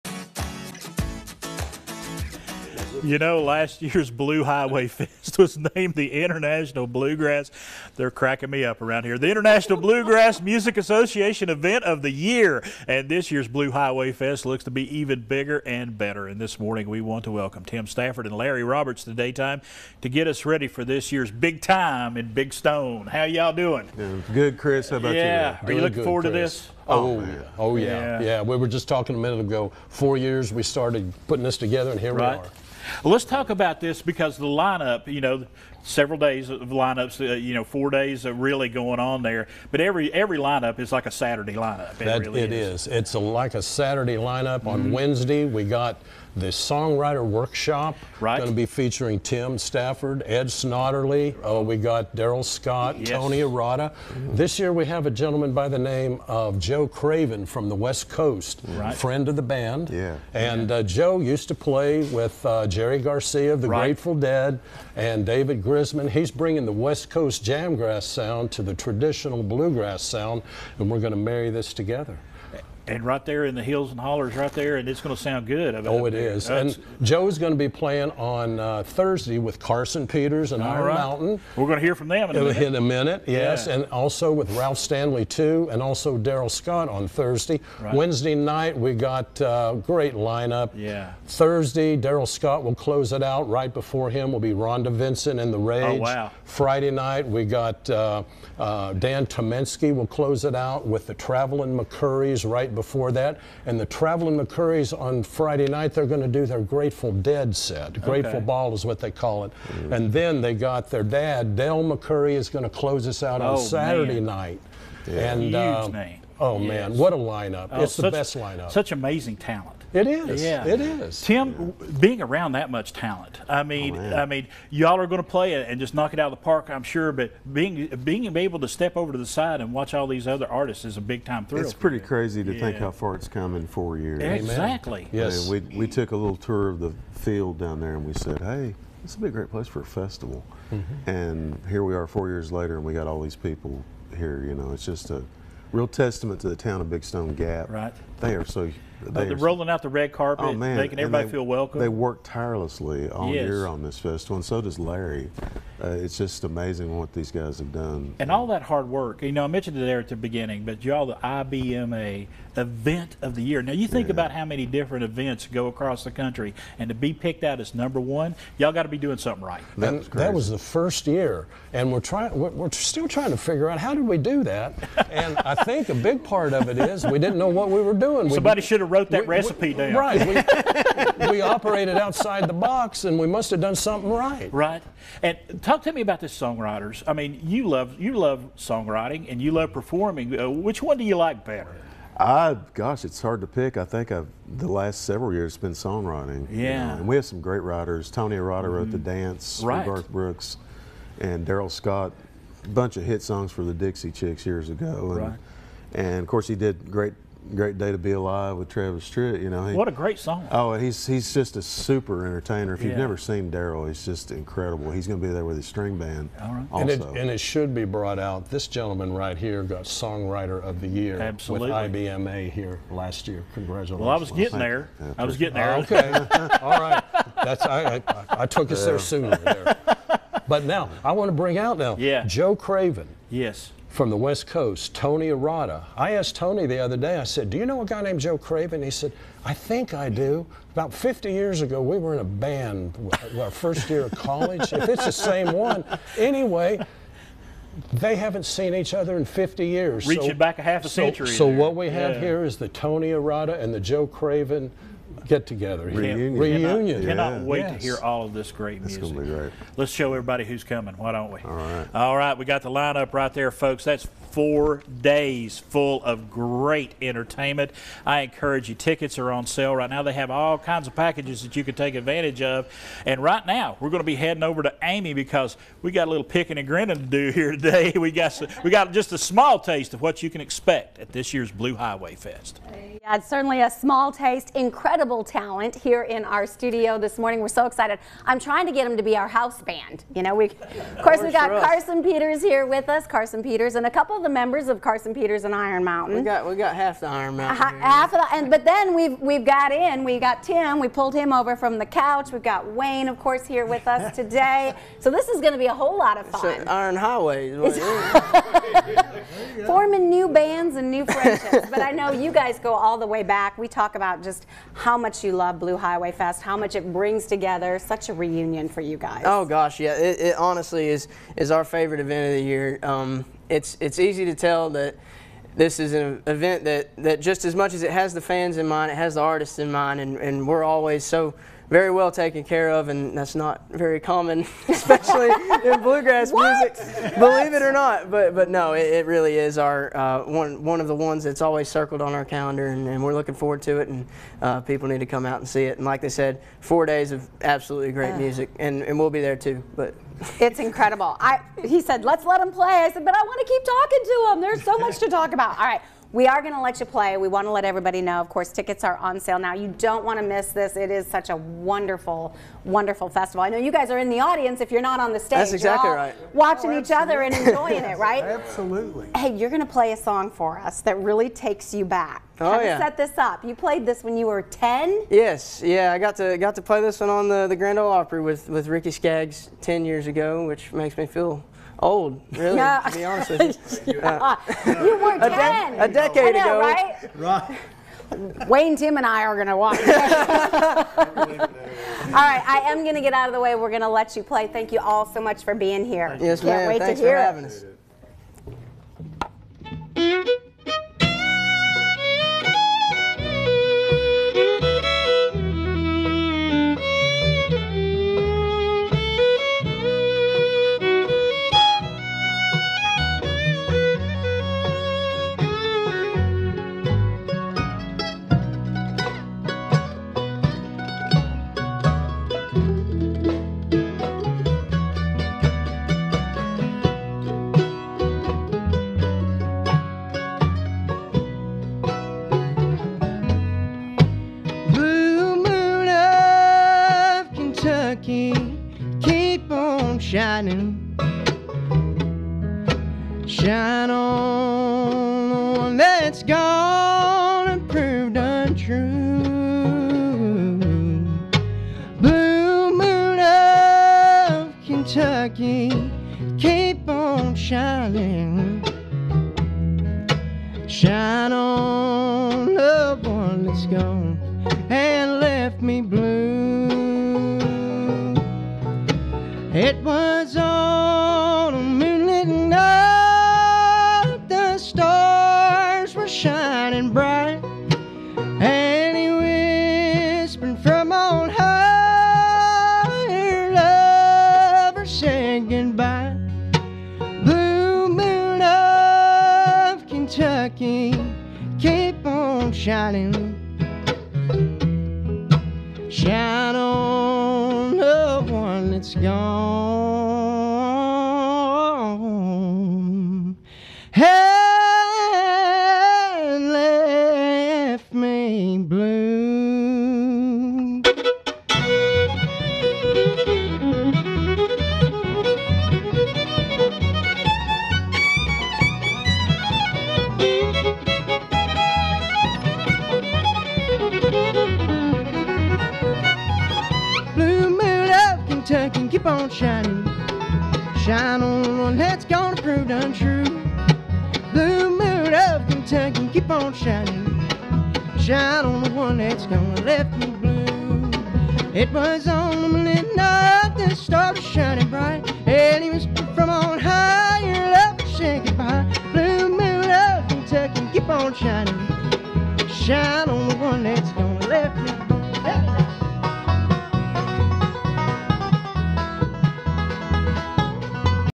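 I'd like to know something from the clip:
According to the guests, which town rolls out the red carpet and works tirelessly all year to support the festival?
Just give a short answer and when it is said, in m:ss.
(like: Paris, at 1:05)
Big Stone Gap, at 2:26.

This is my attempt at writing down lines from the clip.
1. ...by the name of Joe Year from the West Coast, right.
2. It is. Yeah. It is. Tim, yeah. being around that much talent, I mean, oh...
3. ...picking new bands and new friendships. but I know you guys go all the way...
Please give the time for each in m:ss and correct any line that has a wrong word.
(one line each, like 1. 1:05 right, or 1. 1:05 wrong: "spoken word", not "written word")
1. 0:55 wrong: "Craven", not "Year"
2. 1:59 right
3. 5:09 wrong: "forming", not "picking".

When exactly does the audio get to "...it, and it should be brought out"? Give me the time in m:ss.
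3:37.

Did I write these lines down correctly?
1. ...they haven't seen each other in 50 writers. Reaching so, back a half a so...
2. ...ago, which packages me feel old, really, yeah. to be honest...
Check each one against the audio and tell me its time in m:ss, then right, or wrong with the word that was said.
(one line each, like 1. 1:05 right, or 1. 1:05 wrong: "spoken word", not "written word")
1. 4:07 wrong: "years", not "writers"
2. 6:20 wrong: "makes", not "packages".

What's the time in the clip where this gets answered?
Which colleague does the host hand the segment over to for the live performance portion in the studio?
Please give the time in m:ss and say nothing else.
4:34.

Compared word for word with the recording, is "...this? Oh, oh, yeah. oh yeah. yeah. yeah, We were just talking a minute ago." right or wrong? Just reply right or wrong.
right.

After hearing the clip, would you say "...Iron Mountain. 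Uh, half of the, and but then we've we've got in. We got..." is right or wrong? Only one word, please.
right.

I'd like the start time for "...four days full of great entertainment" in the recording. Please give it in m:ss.
4:24.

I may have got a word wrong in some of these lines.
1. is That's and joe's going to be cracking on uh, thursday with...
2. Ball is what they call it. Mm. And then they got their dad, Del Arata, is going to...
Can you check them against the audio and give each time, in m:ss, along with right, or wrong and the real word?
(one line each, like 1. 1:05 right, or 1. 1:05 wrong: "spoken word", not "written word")
1. 1:16 wrong: "playing", not "cracking"
2. 1:48 wrong: "McCoury", not "Arata".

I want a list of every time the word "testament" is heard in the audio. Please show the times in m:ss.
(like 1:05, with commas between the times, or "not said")
2:25.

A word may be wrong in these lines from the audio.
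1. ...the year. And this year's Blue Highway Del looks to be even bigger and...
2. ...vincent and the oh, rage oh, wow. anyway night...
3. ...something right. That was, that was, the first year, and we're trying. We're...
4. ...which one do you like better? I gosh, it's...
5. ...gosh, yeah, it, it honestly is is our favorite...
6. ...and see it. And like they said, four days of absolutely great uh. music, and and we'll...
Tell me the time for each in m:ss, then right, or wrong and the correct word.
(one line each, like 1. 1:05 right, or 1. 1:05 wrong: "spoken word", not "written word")
1. 0:12 wrong: "Fest", not "Del"
2. 1:34 wrong: "friday", not "anyway"
3. 2:49 right
4. 3:10 right
5. 5:19 right
6. 5:45 right.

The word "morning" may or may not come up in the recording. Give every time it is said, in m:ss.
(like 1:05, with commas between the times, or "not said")
0:16, 4:47.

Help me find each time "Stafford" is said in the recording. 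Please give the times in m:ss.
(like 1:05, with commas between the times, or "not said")
0:17, 0:49.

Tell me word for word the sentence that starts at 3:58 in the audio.
He said, I think I do.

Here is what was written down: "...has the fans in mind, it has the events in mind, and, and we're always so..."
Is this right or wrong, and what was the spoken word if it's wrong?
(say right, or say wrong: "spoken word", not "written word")
wrong: "artists", not "events".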